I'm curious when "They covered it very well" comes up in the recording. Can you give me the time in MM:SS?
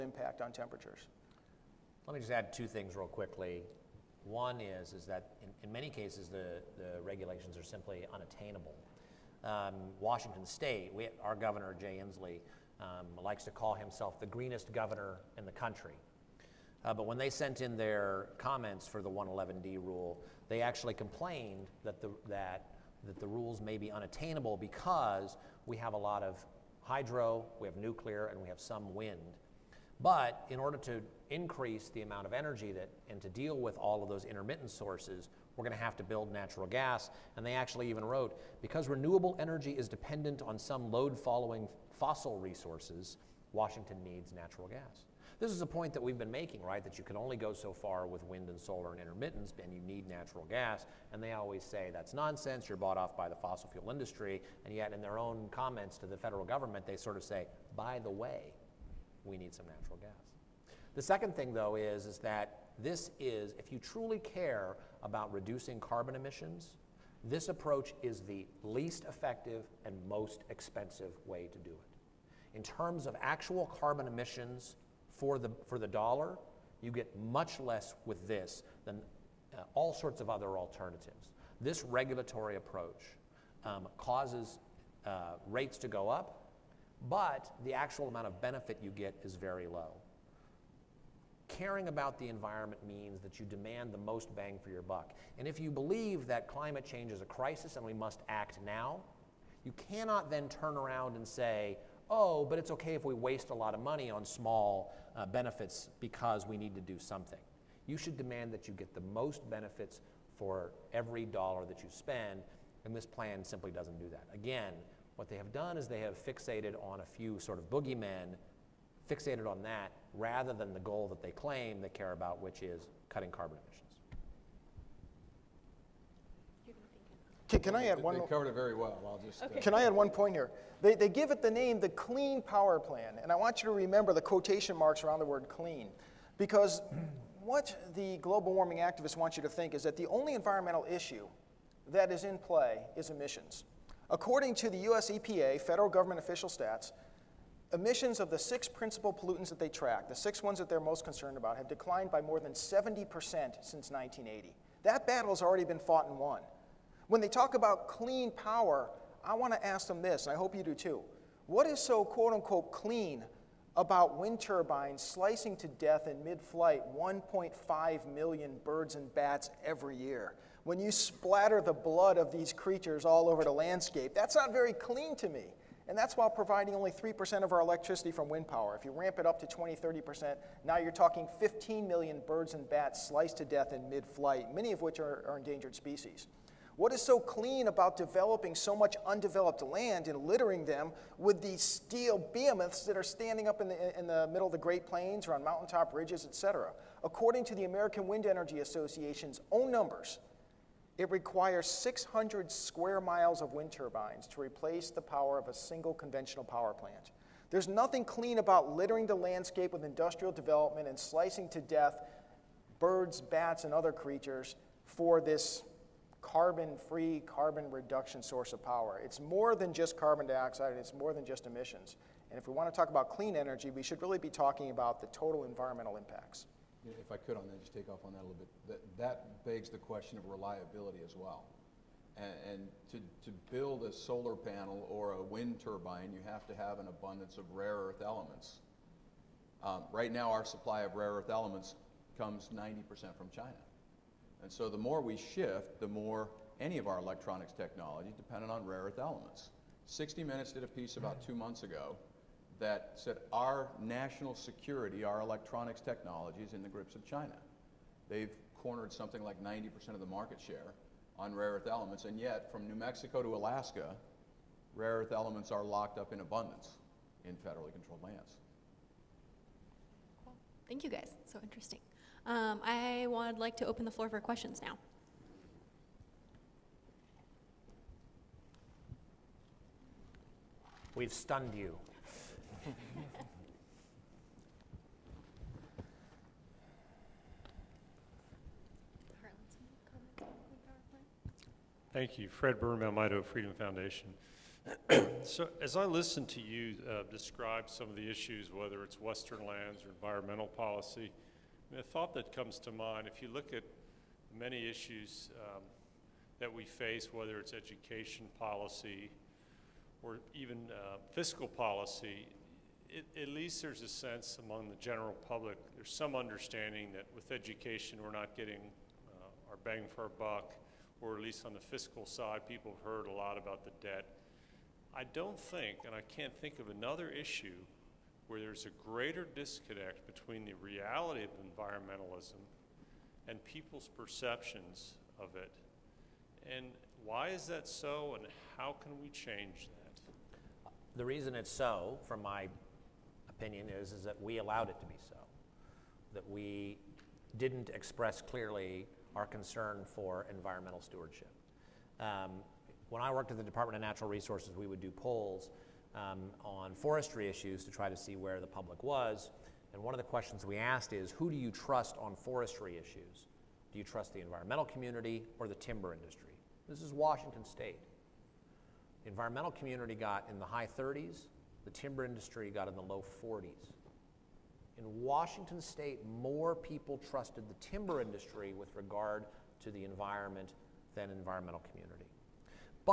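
02:08.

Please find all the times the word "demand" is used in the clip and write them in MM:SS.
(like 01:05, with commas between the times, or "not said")
01:33, 01:48.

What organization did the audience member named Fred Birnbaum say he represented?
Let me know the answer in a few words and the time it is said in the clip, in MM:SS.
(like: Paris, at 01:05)
Idaho Freedom Foundation, at 04:52.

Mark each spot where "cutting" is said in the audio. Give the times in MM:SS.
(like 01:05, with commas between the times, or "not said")
02:03.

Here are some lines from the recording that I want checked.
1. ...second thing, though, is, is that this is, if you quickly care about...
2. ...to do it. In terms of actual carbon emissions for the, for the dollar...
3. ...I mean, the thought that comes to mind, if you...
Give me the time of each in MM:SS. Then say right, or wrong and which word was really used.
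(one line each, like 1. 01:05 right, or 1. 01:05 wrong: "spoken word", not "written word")
1. 01:01 wrong: "truly", not "quickly"
2. 01:11 right
3. 05:01 right.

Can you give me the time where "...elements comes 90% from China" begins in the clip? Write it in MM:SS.
04:01.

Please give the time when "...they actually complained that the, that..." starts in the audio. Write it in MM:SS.
00:20.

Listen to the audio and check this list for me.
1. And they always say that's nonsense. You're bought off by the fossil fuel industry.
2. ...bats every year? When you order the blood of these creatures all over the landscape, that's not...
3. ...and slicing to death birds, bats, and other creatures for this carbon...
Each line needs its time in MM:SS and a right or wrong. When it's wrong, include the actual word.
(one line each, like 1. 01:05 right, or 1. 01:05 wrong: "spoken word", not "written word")
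1. 00:51 right
2. 02:49 wrong: "splatter", not "order"
3. 03:30 right.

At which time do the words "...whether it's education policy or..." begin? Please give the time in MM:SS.
05:07.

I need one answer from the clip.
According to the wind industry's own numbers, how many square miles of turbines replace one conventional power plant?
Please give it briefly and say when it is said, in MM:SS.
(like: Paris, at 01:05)
600, at 03:21.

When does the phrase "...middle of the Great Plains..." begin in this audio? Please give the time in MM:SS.
03:14.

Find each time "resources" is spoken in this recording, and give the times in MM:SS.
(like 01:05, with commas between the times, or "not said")
00:42, 05:54.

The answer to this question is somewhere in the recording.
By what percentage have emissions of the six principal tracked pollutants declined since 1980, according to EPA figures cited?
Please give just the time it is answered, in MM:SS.
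02:32.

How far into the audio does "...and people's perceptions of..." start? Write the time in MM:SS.
05:33.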